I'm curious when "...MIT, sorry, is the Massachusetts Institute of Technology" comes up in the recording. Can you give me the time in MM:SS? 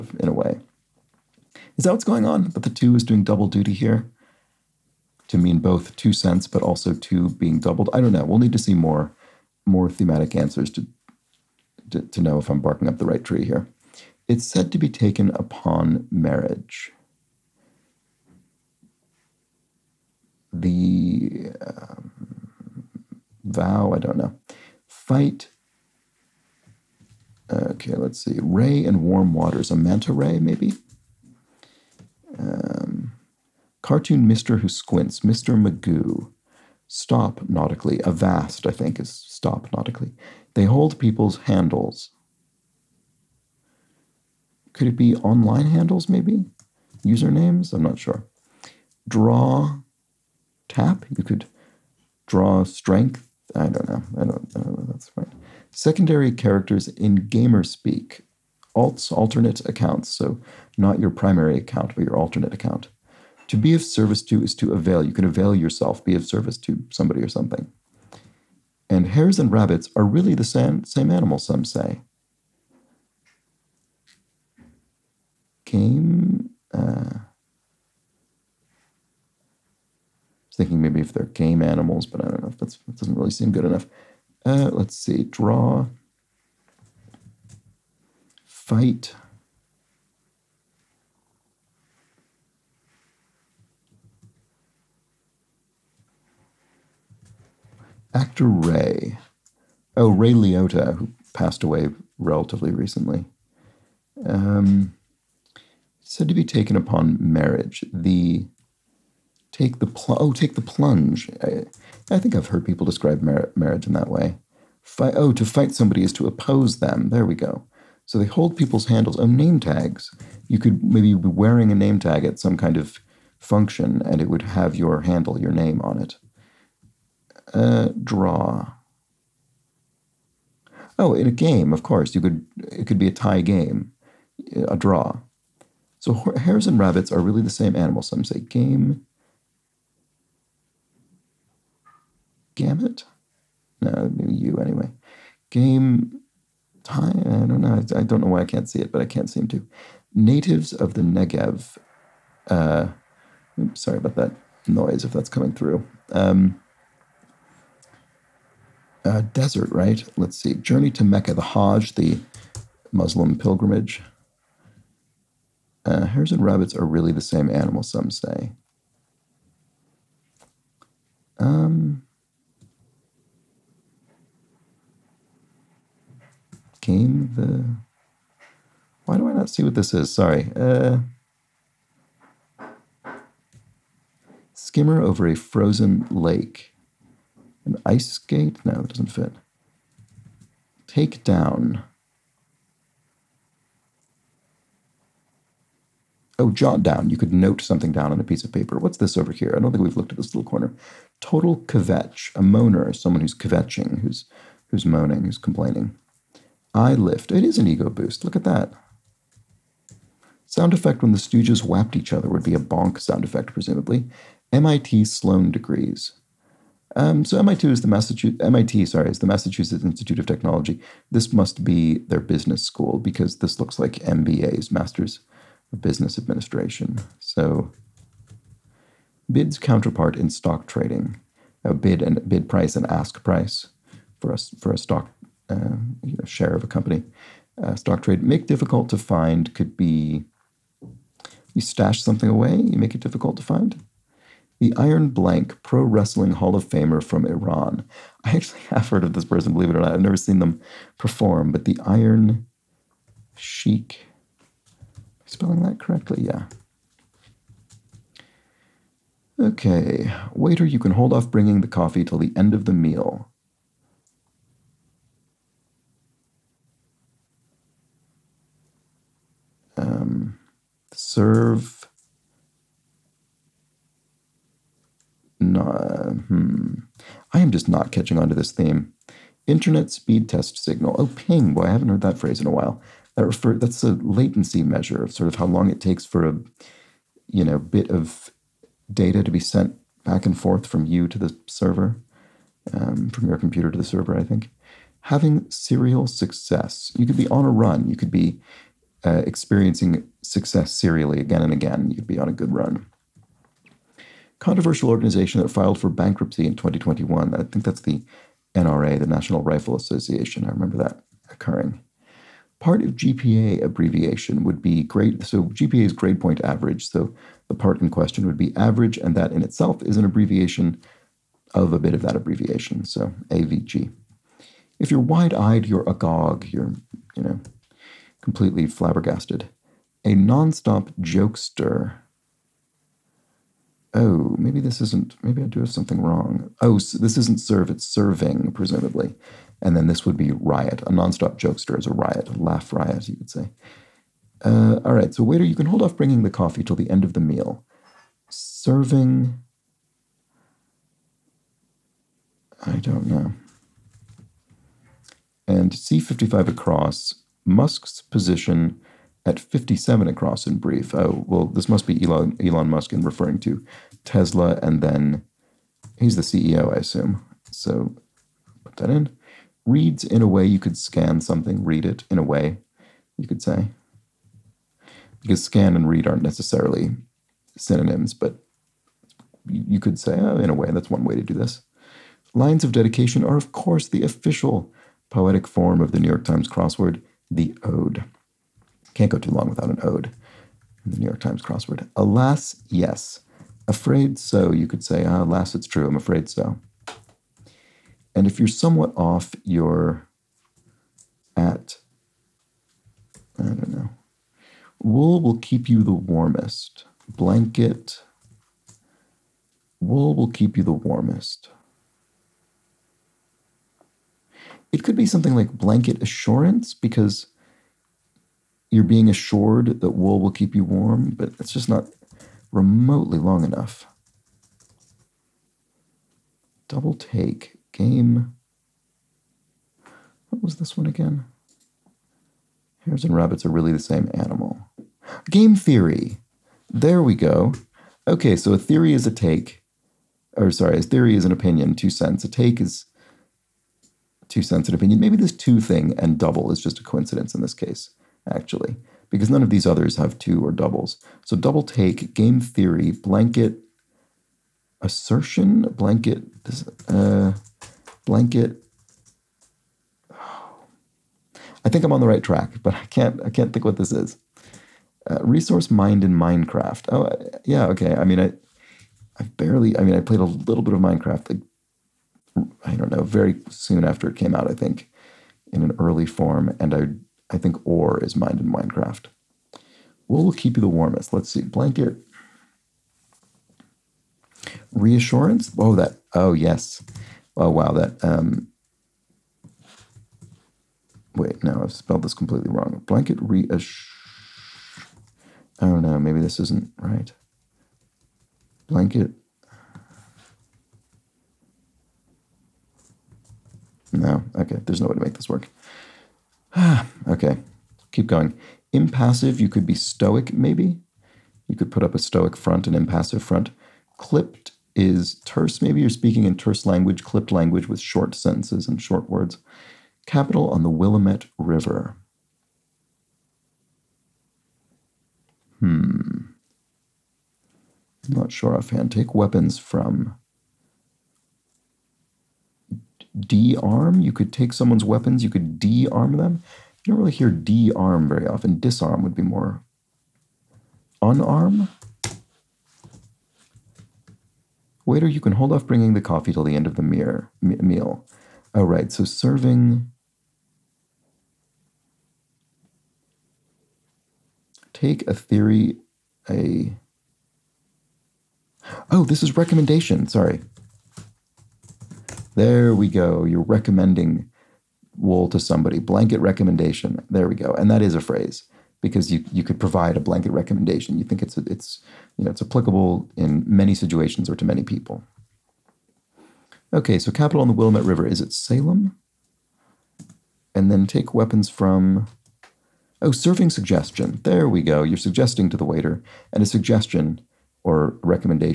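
03:38.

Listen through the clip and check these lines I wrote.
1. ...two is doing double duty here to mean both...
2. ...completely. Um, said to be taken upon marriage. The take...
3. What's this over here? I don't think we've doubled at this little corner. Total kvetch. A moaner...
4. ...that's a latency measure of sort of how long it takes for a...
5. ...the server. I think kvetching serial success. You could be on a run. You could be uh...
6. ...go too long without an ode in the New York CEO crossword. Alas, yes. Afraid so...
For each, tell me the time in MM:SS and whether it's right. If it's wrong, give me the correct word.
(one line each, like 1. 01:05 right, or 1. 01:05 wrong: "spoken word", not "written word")
1. 00:02 right
2. 01:42 wrong: "recently", not "completely"
3. 03:18 wrong: "looked", not "doubled"
4. 04:43 right
5. 04:53 wrong: "having", not "kvetching"
6. 06:29 wrong: "Times", not "CEO".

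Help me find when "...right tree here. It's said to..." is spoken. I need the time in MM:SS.
00:13.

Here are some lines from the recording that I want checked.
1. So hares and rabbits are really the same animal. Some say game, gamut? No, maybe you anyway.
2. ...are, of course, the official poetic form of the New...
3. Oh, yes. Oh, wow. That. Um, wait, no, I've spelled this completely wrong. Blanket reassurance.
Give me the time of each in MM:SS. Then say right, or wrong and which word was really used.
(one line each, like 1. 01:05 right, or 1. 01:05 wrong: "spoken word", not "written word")
1. 02:15 right
2. 06:23 right
3. 08:06 right.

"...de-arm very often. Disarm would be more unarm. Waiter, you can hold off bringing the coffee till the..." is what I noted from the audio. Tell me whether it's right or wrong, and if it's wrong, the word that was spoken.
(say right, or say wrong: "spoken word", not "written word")
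right.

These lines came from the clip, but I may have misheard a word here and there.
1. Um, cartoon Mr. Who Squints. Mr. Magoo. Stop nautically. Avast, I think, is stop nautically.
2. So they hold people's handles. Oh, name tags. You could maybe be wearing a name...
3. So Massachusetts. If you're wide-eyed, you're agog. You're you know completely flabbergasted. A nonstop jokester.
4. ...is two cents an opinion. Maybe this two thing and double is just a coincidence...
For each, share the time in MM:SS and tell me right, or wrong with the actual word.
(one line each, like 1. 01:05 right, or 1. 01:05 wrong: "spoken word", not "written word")
1. 00:32 right
2. 01:58 right
3. 05:22 wrong: "AVG", not "Massachusetts"
4. 07:22 right.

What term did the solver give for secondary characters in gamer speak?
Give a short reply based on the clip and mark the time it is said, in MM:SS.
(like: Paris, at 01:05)
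Alts, at 00:58.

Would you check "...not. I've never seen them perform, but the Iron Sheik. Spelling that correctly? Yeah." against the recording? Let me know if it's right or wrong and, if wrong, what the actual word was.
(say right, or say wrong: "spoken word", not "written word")
right.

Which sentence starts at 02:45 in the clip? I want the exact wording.
Uh, hares and rabbits are really the same animal, some say.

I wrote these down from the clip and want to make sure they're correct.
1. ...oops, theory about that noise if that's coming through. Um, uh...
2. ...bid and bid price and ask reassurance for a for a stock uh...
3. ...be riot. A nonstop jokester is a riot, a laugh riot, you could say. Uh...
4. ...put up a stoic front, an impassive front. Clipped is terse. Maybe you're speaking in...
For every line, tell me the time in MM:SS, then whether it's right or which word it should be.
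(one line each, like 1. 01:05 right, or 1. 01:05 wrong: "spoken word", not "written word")
1. 02:33 wrong: "sorry", not "theory"
2. 03:51 wrong: "price", not "reassurance"
3. 05:40 right
4. 08:31 right.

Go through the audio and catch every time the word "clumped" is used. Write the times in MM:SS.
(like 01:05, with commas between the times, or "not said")
not said.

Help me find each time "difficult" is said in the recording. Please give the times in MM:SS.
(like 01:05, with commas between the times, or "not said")
03:58, 04:03.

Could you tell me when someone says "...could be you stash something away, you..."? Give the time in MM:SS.
03:59.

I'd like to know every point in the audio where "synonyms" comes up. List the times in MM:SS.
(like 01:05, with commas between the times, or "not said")
06:17.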